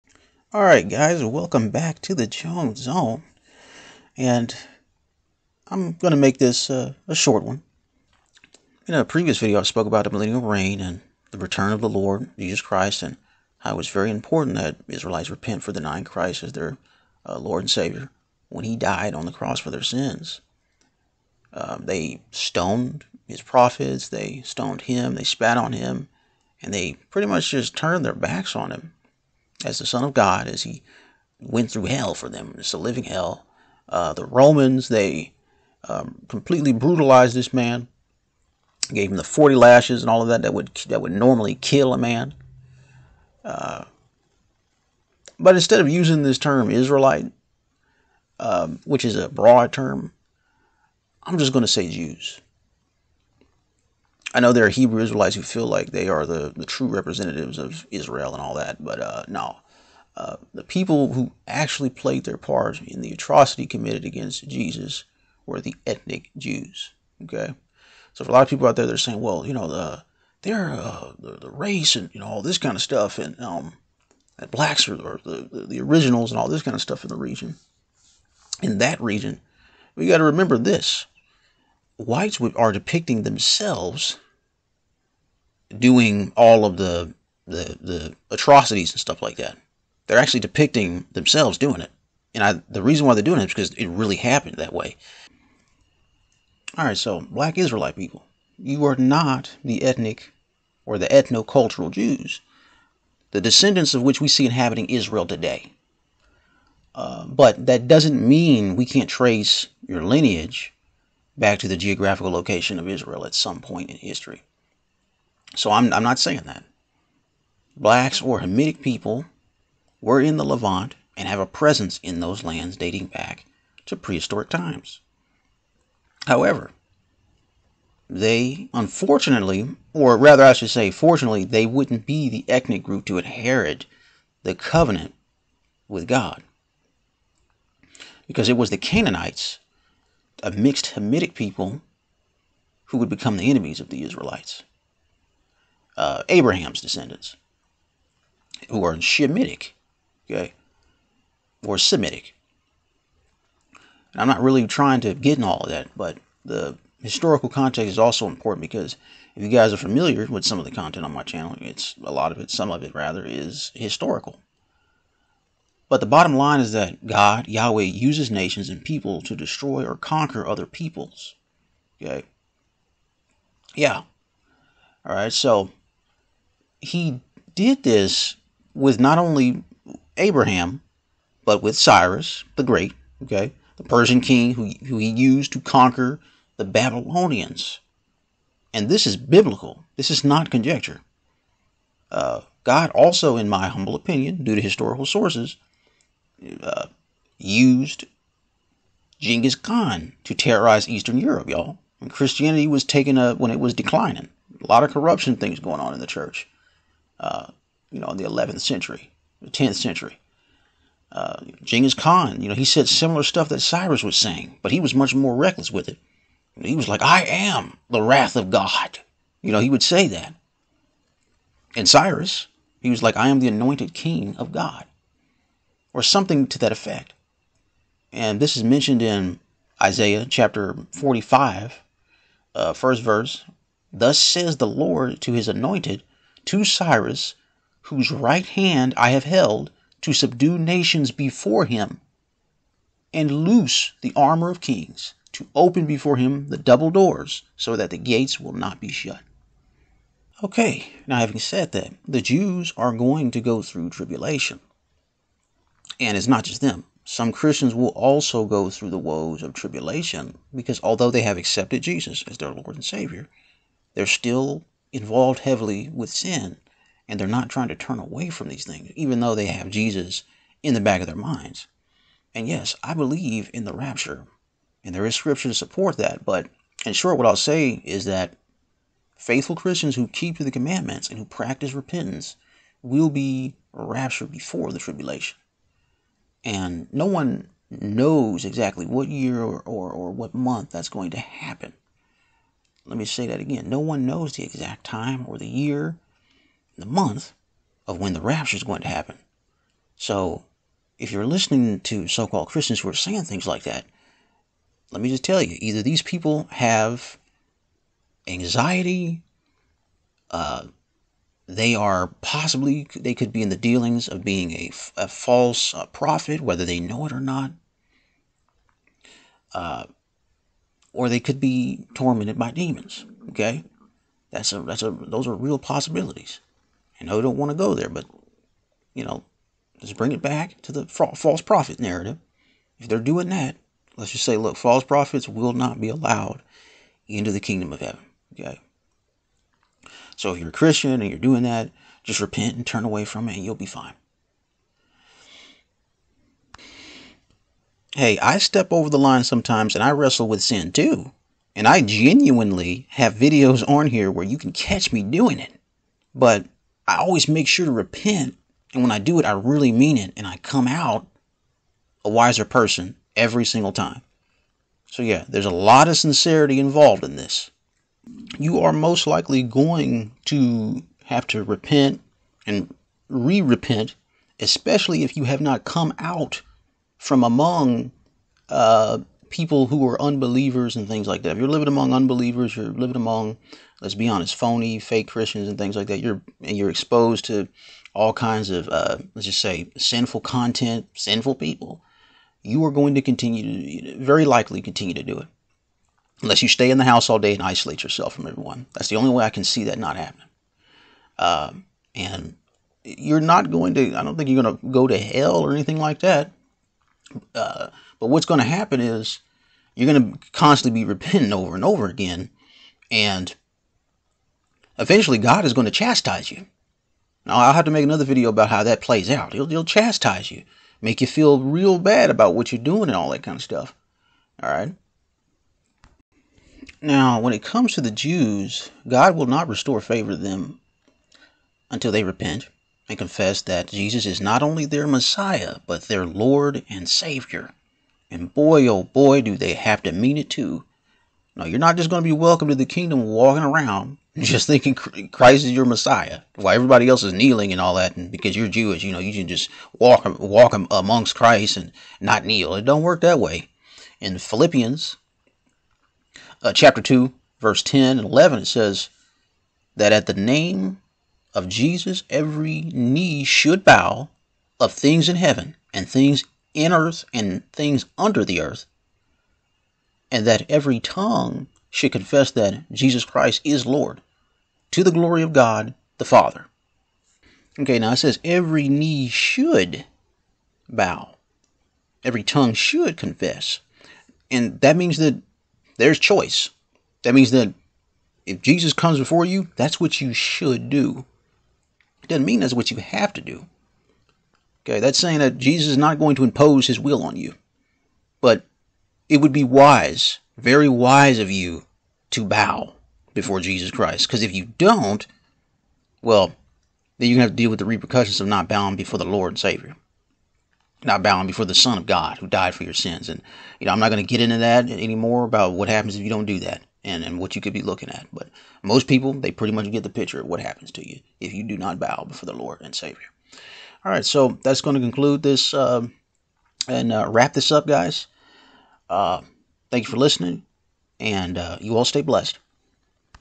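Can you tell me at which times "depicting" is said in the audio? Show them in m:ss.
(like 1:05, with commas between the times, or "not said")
1:22, 1:30.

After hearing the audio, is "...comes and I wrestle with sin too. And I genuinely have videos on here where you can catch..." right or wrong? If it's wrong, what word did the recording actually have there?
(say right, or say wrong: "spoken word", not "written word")
wrong: "sometimes", not "comes".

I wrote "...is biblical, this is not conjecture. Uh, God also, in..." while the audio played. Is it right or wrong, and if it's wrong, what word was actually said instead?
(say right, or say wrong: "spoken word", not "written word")
right.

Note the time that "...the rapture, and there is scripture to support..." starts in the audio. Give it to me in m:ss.
4:33.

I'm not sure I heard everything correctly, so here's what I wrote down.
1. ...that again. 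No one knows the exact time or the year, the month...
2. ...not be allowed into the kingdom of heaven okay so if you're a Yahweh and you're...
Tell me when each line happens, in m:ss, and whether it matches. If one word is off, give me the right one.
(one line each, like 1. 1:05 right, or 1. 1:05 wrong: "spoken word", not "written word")
1. 4:53 right
2. 5:35 wrong: "Christian", not "Yahweh".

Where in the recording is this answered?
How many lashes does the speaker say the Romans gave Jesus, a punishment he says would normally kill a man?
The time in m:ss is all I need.
0:39.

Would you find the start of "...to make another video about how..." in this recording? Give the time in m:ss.
6:57.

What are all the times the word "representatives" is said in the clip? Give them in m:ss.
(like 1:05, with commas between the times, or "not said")
0:56.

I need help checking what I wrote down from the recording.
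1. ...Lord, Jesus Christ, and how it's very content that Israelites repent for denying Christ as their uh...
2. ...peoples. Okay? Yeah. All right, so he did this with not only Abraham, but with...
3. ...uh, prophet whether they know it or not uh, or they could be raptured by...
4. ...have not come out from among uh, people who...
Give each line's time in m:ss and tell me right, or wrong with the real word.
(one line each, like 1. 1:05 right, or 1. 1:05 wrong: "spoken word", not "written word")
1. 0:11 wrong: "important", not "content"
2. 2:50 right
3. 5:15 wrong: "tormented", not "raptured"
4. 6:15 right.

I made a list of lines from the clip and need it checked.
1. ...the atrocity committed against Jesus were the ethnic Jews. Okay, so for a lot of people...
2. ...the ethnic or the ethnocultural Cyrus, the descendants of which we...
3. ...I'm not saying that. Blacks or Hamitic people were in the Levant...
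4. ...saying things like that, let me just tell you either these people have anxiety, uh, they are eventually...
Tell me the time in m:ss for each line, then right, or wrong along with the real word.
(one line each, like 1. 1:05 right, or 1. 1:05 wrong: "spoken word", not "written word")
1. 1:03 right
2. 1:39 wrong: "Jews", not "Cyrus"
3. 1:55 right
4. 5:02 wrong: "possibly", not "eventually".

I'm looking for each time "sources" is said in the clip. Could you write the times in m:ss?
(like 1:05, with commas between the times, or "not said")
3:15.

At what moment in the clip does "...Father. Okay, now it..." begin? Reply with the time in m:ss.
7:56.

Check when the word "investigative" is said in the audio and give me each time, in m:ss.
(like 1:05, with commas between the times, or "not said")
not said.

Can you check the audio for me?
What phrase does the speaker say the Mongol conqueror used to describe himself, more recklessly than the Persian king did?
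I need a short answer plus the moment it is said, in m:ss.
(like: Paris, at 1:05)
I am the wrath of God, at 3:37.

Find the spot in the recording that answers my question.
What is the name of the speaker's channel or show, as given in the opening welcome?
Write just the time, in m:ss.
0:02.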